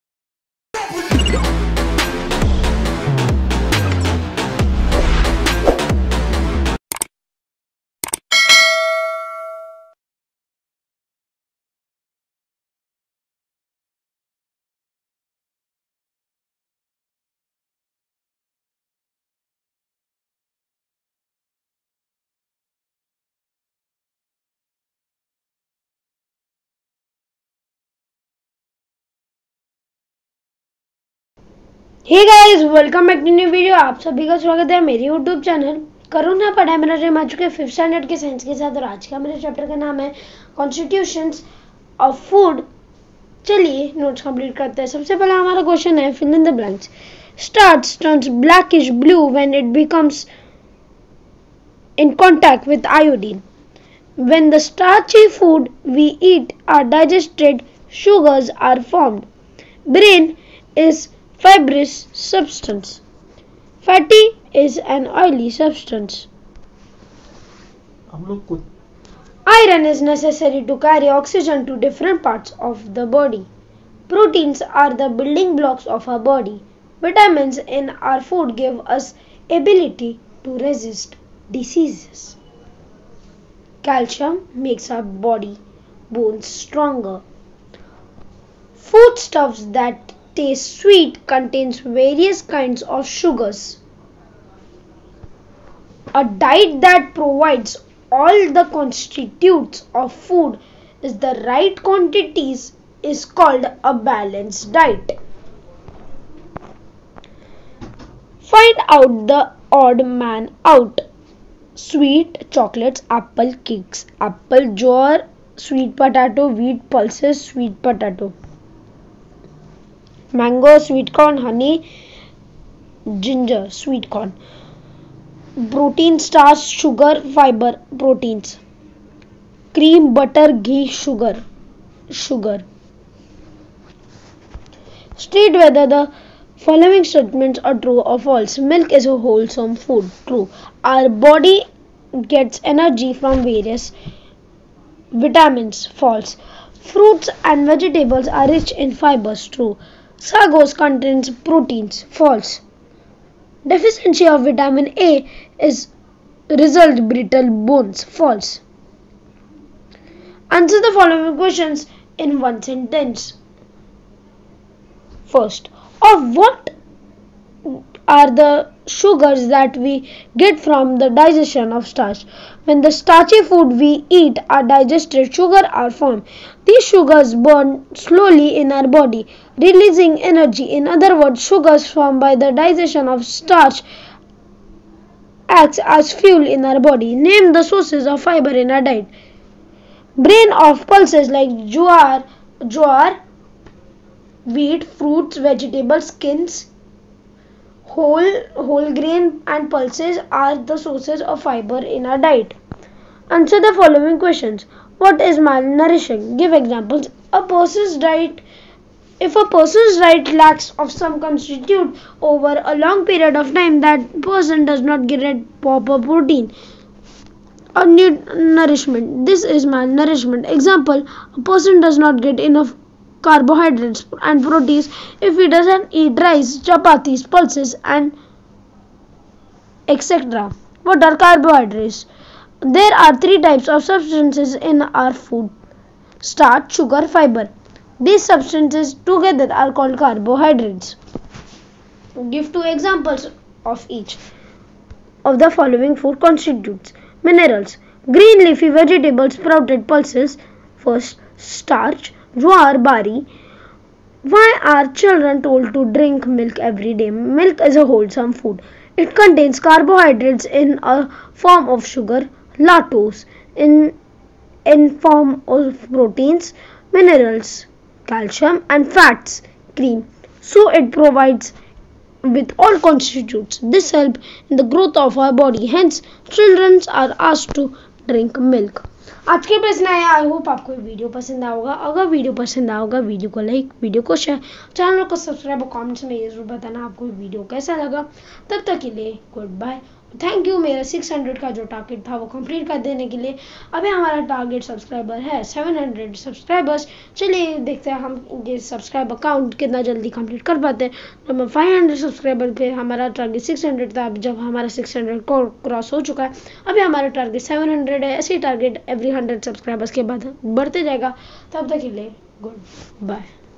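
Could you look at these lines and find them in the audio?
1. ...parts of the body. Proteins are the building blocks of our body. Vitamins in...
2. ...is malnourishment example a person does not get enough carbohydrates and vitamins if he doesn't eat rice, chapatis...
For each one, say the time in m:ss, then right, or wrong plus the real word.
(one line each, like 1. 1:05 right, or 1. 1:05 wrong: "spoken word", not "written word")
1. 1:12 right
2. 3:39 wrong: "proteins", not "vitamins".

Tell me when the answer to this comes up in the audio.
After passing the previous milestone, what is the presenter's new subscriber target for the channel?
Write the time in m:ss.
4:55.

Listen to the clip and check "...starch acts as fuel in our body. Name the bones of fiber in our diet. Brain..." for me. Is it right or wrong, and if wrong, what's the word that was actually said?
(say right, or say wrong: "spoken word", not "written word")
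wrong: "sources", not "bones".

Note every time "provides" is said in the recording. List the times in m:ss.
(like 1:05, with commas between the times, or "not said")
1:37, 4:30.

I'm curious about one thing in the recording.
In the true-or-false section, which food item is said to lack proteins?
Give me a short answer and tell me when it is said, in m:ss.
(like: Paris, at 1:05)
Sago, at 2:30.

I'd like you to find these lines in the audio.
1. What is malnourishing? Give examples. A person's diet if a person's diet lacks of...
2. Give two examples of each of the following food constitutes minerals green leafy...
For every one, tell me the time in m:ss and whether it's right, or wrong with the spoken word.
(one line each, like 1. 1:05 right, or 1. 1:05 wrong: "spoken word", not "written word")
1. 3:24 right
2. 4:02 right.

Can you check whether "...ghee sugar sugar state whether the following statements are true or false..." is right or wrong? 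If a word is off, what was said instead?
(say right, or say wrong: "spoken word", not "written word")
right.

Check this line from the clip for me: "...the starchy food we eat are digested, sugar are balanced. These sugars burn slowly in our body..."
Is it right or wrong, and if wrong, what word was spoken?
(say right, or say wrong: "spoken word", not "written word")
wrong: "formed", not "balanced".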